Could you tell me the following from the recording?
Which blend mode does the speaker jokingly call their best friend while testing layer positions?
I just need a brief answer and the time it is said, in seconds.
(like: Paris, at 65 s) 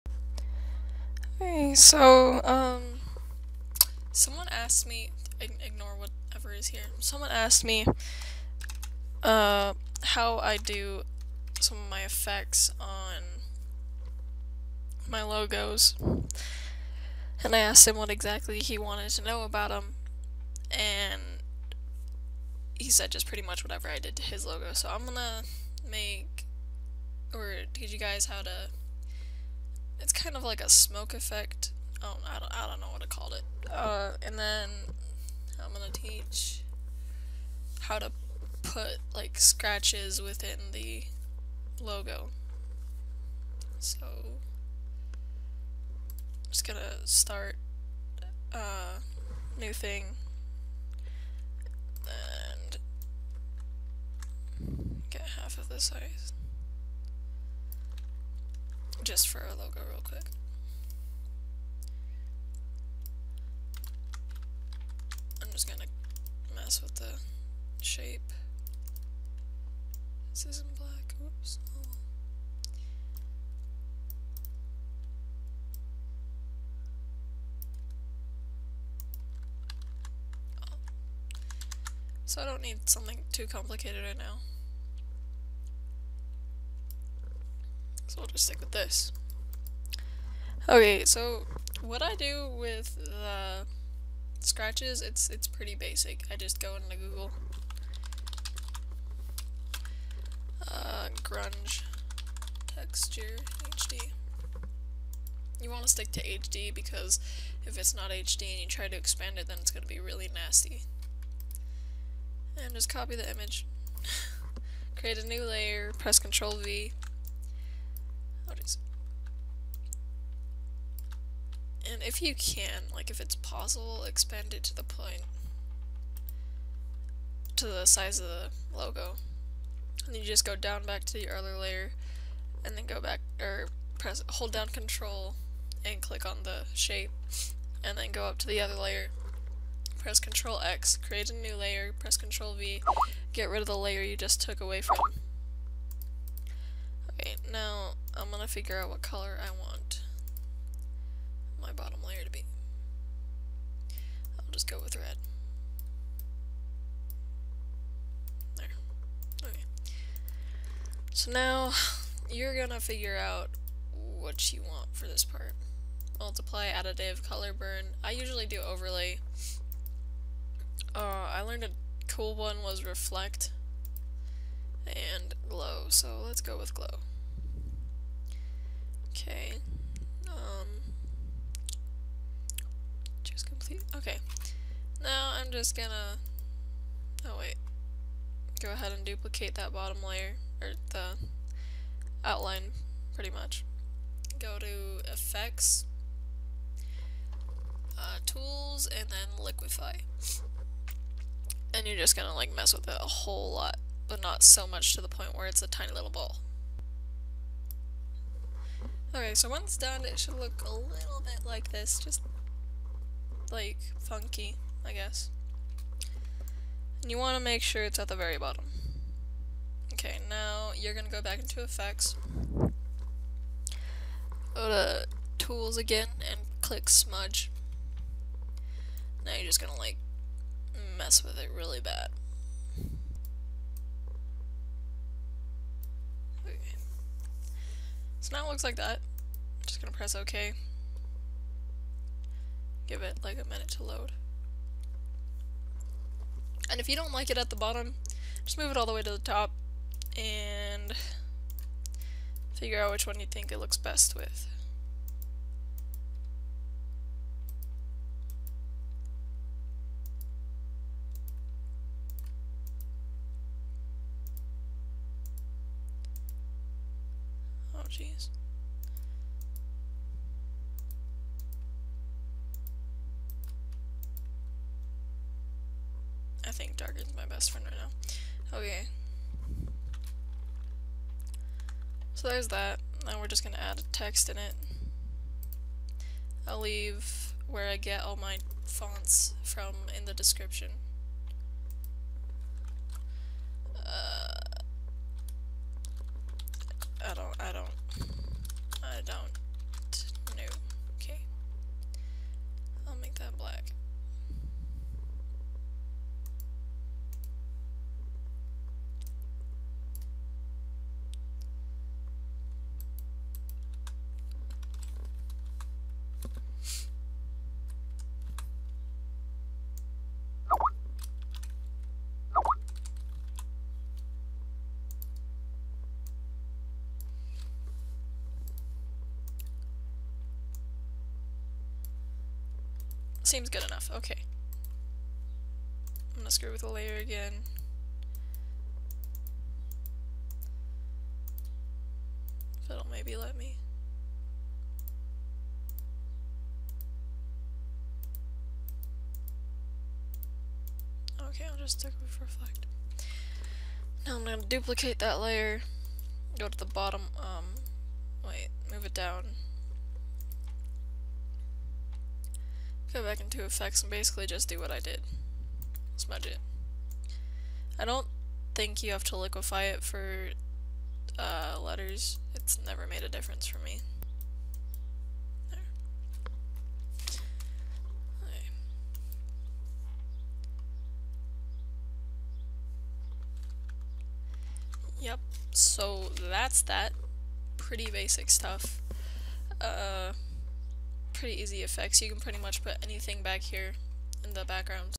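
Darken, at 276 s.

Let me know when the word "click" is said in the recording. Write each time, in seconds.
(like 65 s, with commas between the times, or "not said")
136 s, 226 s.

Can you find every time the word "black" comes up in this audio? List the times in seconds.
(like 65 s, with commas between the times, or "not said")
70 s, 303 s.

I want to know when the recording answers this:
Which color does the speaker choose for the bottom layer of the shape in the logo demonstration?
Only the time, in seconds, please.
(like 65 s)
154 s.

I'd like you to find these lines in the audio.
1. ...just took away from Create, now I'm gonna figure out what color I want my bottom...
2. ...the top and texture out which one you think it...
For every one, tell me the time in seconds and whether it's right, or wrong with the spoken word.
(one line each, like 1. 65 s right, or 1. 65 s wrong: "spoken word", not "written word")
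1. 144 s wrong: "Okay", not "Create"
2. 249 s wrong: "figure", not "texture".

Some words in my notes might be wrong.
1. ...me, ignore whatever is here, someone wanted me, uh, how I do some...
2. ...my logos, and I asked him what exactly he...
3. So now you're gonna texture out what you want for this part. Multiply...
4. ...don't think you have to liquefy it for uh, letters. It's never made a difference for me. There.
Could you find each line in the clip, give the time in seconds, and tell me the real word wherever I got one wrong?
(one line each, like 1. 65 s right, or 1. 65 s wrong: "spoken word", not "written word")
1. 4 s wrong: "asked", not "wanted"
2. 15 s right
3. 161 s wrong: "figure", not "texture"
4. 367 s right.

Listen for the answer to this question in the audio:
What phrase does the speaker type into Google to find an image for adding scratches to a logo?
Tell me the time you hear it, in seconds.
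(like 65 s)
101 s.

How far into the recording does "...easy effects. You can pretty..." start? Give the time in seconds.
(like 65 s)
391 s.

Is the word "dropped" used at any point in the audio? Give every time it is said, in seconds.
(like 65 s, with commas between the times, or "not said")
not said.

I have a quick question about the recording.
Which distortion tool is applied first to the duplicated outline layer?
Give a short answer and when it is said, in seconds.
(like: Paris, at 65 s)
Liquify, at 199 s.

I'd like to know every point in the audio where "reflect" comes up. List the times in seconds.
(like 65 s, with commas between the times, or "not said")
172 s, 352 s.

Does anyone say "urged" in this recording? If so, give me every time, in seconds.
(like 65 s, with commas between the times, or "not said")
not said.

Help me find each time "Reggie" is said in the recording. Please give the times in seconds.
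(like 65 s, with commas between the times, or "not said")
not said.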